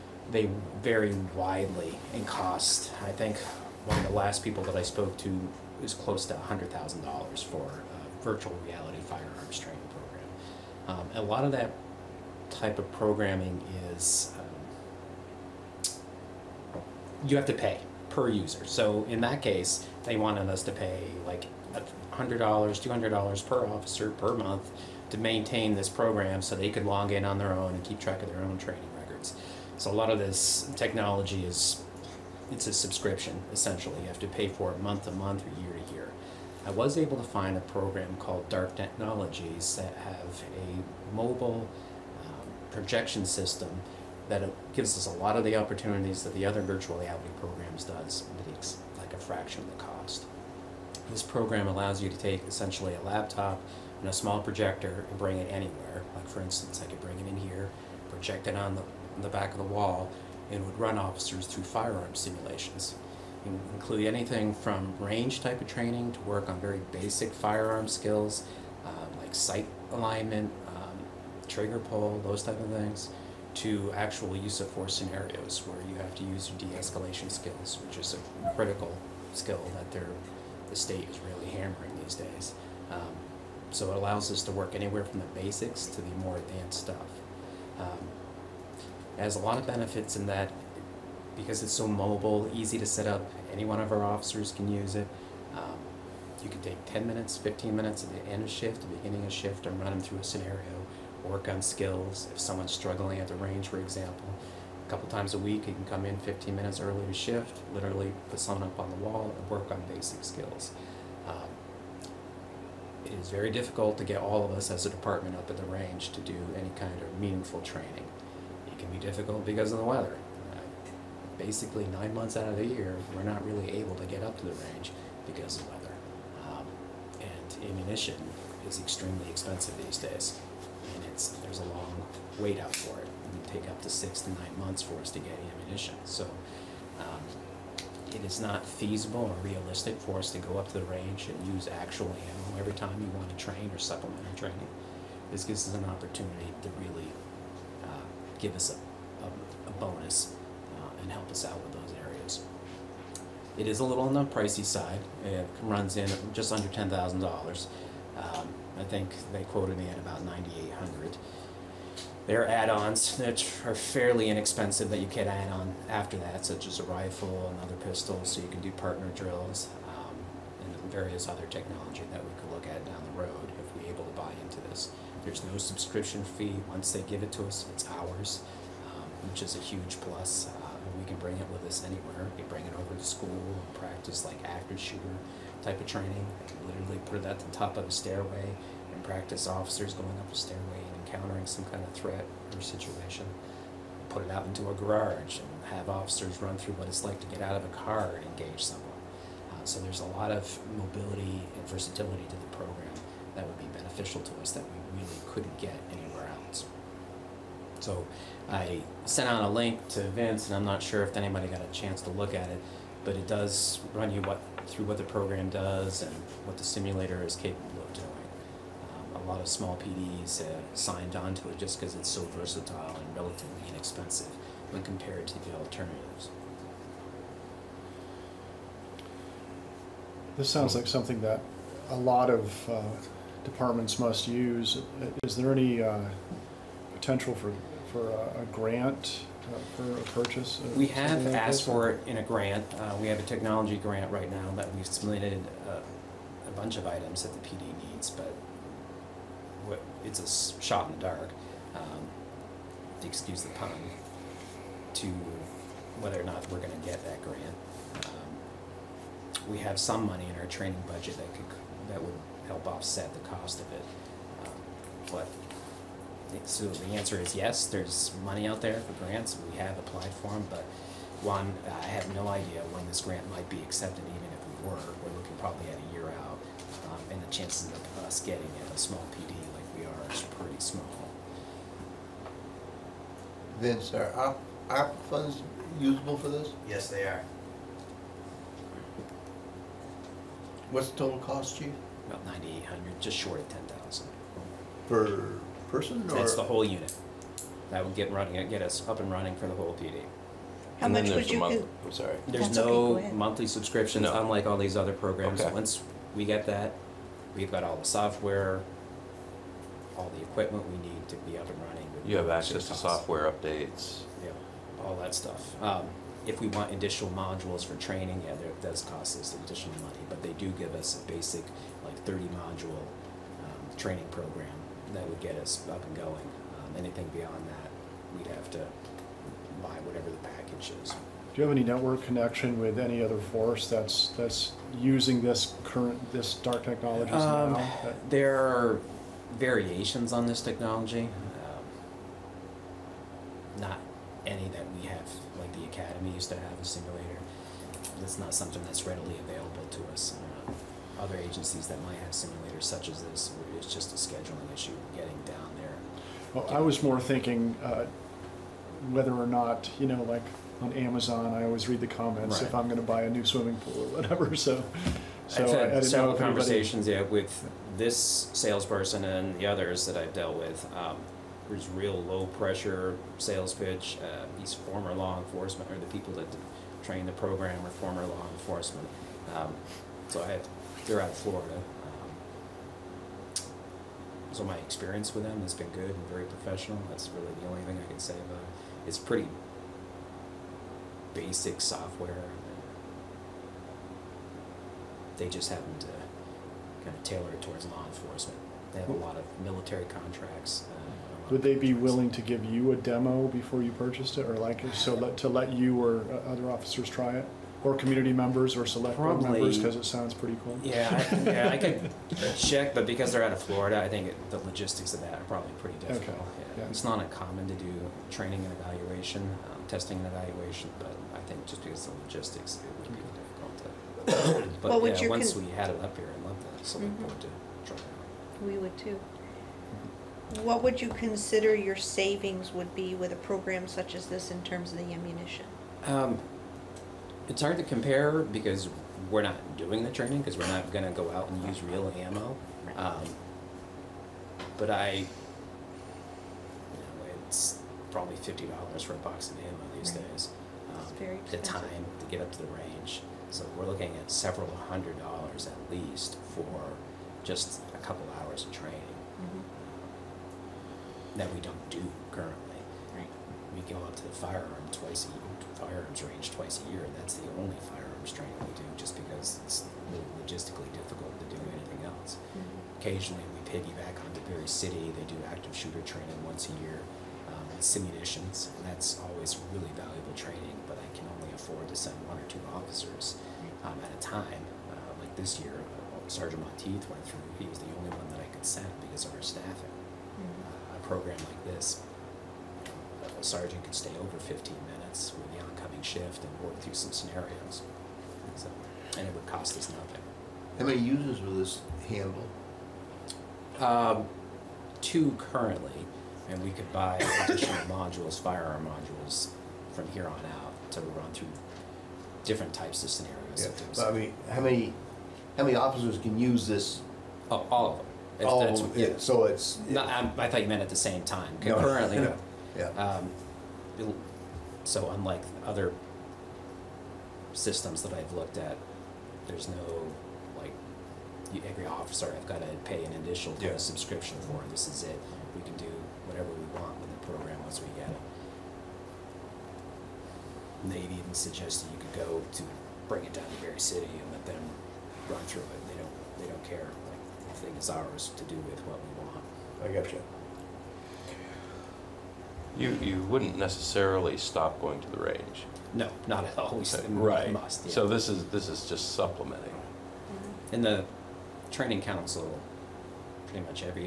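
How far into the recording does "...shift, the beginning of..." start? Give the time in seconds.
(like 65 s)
98 s.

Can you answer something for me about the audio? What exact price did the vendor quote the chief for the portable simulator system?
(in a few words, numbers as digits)
9,800.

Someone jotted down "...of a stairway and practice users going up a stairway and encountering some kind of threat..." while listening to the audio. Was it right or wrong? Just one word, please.
wrong.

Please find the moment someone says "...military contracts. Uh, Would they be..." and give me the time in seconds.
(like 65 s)
399 s.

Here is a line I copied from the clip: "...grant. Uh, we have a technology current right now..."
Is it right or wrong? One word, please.
wrong.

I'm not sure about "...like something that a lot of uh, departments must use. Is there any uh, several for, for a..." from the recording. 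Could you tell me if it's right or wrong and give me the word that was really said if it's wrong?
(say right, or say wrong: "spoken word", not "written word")
wrong: "potential", not "several".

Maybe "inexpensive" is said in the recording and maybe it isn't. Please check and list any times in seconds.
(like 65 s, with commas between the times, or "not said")
164 s, 223 s.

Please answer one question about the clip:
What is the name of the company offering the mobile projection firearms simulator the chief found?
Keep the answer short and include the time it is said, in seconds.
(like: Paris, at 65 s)
Dark Technologies, at 38 s.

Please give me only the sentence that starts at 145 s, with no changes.
This gives us an opportunity to really uh, give us a, a, a bonus uh, and help us out with those areas.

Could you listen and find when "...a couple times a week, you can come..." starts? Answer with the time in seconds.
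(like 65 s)
104 s.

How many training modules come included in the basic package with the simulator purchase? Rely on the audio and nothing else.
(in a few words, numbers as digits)
30.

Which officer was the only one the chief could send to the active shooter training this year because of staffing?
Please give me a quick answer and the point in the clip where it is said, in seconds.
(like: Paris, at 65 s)
Sergeant Monteith, at 486 s.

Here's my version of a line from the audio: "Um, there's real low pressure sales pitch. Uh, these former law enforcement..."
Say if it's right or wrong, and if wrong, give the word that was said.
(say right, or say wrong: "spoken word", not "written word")
right.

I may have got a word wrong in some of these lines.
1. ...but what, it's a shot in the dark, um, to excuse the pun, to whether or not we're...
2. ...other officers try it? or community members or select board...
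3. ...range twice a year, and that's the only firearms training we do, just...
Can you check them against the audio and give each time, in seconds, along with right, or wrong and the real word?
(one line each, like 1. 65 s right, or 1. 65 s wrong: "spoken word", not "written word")
1. 248 s right
2. 406 s right
3. 466 s right.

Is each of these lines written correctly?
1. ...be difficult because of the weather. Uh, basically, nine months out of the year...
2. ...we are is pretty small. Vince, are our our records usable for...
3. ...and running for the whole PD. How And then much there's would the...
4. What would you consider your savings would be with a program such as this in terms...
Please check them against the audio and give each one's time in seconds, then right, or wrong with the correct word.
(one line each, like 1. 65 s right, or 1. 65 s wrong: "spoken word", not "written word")
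1. 118 s right
2. 279 s wrong: "funds", not "records"
3. 298 s right
4. 430 s right.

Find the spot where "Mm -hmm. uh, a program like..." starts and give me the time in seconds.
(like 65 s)
489 s.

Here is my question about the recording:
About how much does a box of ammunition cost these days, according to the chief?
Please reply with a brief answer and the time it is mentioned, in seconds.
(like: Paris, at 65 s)
$50, at 448 s.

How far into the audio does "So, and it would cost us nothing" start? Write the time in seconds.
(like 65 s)
498 s.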